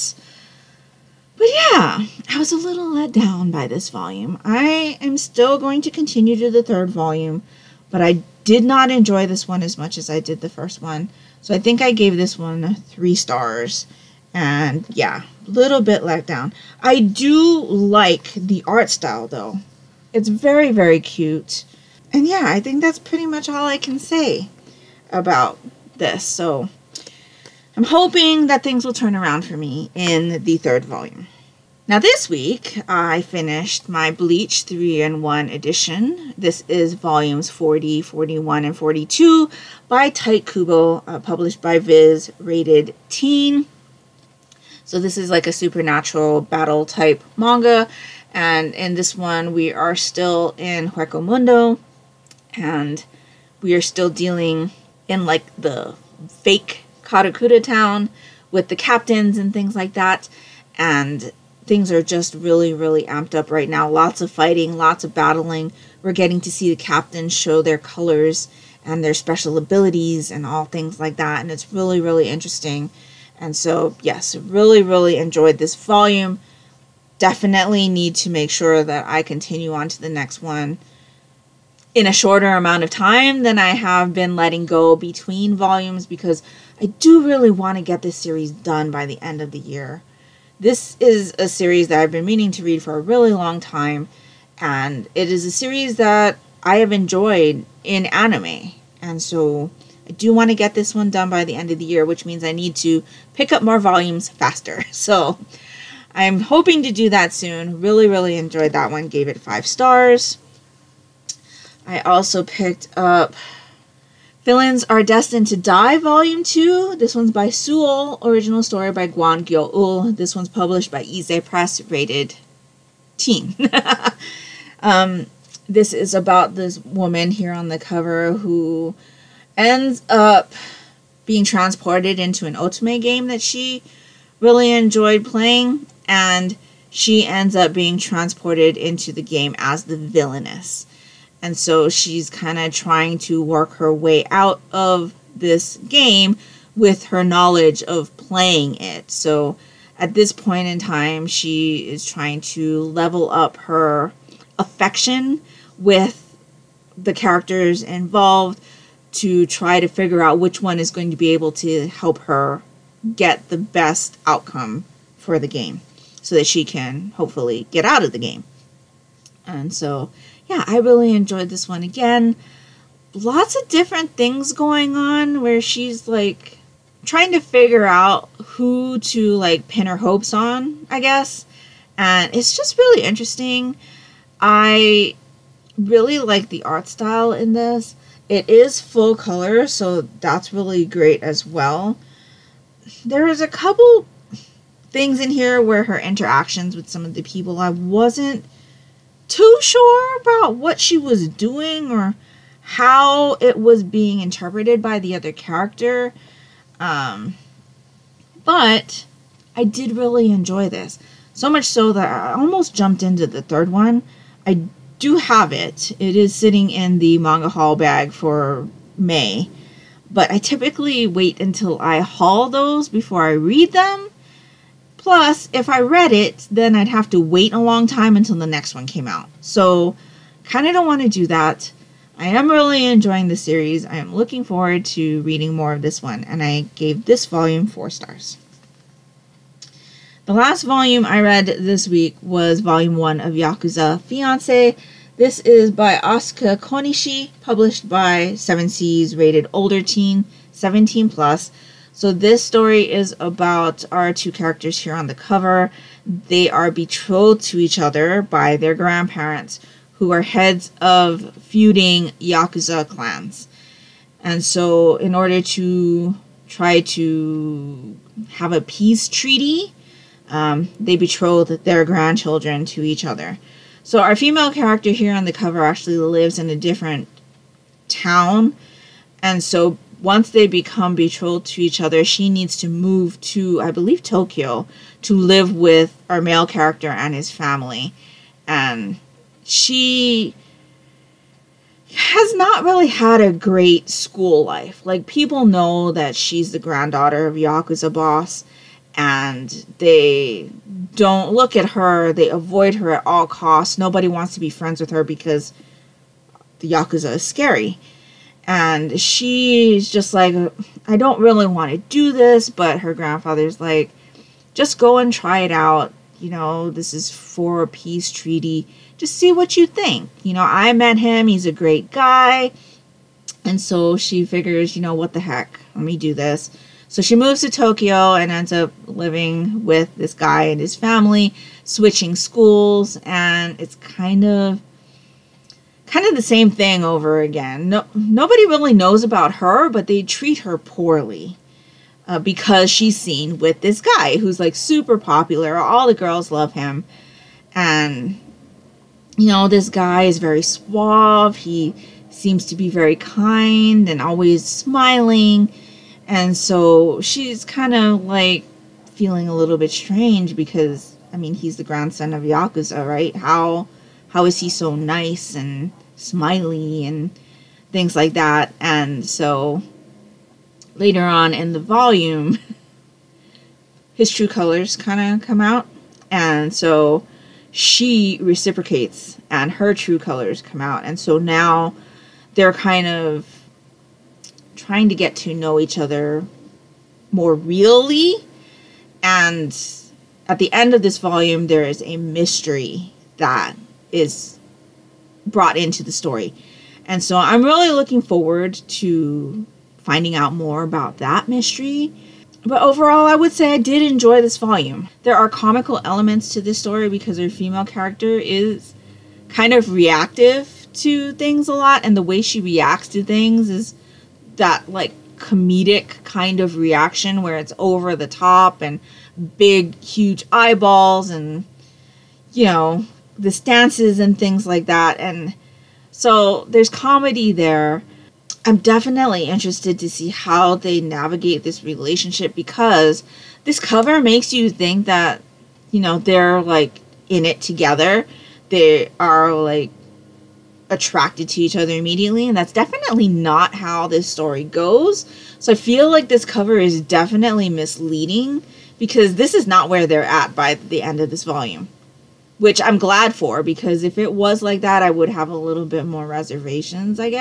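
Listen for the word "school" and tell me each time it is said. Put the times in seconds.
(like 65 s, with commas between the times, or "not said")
293 s, 332 s.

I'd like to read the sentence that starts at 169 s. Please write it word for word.
And so yeah, I really enjoyed this one again.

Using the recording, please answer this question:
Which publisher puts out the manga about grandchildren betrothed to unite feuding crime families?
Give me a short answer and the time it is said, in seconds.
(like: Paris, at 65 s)
Seven Seas, at 248 s.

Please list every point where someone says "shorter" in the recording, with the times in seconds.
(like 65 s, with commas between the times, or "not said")
82 s.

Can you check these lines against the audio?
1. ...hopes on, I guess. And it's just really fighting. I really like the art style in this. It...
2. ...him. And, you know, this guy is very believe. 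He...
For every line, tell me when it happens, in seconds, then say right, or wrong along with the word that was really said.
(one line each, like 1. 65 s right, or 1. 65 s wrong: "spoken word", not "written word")
1. 179 s wrong: "interesting", not "fighting"
2. 346 s wrong: "suave", not "believe".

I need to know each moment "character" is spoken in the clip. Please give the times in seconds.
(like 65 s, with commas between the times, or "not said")
157 s, 205 s, 254 s, 274 s, 286 s, 407 s.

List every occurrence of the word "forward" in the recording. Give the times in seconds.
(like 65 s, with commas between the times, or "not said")
234 s, 398 s.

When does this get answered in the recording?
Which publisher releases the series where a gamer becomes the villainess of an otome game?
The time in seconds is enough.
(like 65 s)
121 s.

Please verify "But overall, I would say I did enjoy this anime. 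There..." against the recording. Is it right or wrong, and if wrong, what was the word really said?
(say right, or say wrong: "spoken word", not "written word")
wrong: "volume", not "anime".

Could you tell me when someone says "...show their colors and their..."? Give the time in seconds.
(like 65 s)
67 s.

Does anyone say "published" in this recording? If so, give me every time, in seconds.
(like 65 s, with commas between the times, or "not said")
41 s, 120 s, 247 s.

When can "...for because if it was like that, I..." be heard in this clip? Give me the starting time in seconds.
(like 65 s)
453 s.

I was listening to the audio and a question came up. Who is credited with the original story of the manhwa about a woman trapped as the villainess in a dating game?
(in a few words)
Gwon Gyoeul.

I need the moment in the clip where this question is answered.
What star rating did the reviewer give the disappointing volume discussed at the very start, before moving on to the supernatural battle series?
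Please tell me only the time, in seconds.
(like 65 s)
12 s.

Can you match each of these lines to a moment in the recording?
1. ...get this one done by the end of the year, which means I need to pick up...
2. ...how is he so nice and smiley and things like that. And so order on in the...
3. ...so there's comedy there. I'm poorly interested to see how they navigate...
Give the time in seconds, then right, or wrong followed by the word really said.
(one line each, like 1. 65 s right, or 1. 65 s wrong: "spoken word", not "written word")
1. 100 s right
2. 364 s wrong: "later", not "order"
3. 425 s wrong: "definitely", not "poorly".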